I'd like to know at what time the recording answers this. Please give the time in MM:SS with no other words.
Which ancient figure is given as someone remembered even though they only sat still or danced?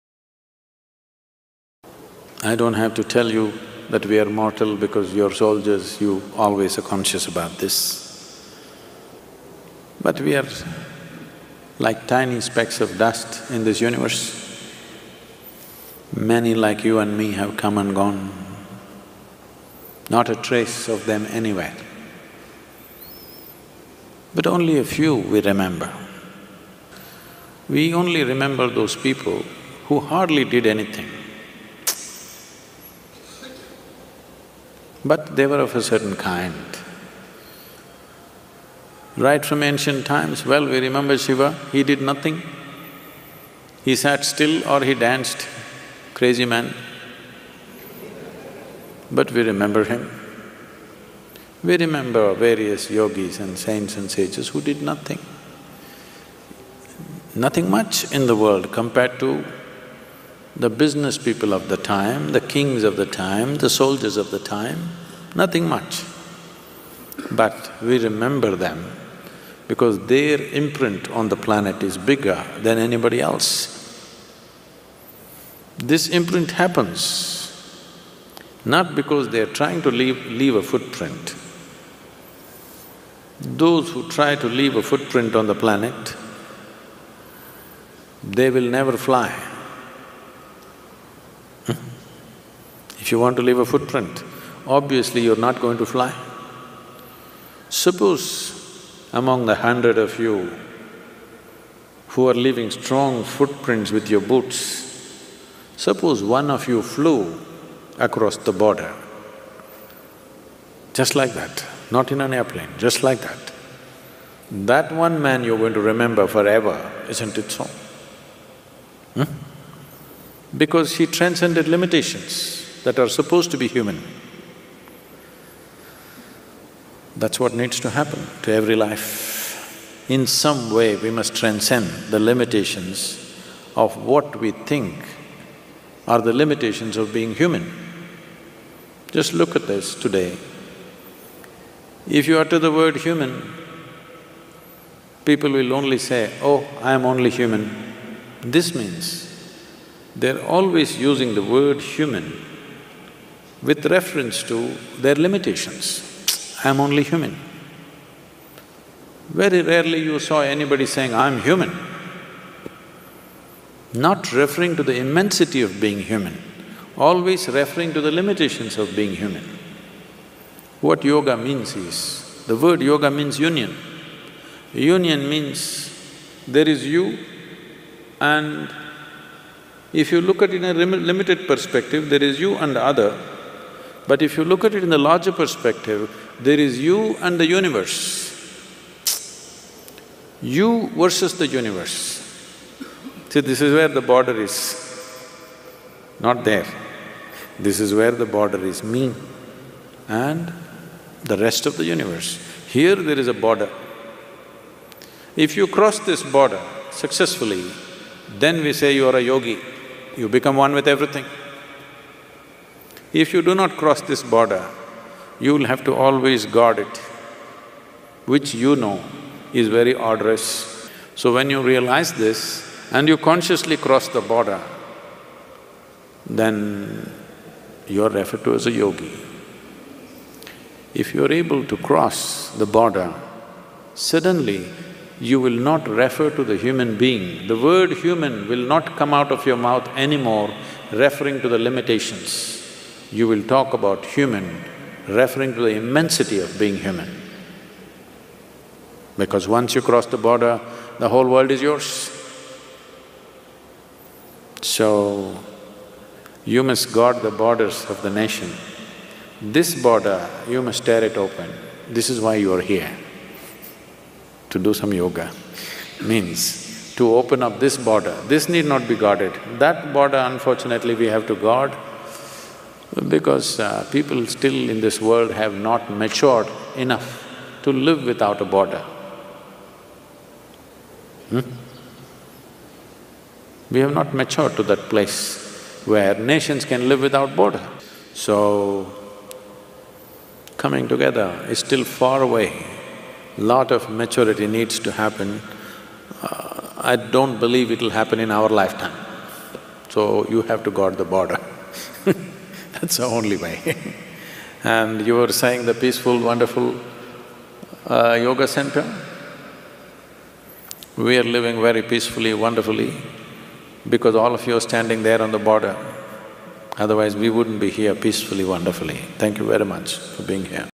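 00:41.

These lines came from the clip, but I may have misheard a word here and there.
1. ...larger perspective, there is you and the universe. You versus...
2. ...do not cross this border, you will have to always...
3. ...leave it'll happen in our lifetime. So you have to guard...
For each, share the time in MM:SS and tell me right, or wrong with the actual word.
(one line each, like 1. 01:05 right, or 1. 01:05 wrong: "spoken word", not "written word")
1. 03:04 right
2. 03:33 right
3. 04:57 wrong: "believe", not "leave".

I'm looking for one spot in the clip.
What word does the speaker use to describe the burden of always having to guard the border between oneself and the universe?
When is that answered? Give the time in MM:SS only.
03:39.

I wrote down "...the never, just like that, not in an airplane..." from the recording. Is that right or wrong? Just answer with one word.
wrong.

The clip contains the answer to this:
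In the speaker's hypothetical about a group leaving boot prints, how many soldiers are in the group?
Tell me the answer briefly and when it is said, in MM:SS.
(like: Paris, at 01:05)
100, at 01:39.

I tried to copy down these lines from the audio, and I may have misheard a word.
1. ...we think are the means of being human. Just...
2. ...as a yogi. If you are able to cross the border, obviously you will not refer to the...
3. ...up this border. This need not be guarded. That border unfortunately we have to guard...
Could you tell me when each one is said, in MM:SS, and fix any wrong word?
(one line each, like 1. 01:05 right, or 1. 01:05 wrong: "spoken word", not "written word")
1. 02:14 wrong: "limitations", not "means"
2. 03:48 wrong: "suddenly", not "obviously"
3. 04:27 right.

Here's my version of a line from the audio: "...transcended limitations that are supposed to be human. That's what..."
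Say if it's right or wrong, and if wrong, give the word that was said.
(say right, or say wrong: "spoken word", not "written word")
right.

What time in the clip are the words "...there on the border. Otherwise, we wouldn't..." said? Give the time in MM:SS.
05:15.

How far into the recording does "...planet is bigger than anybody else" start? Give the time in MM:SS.
01:11.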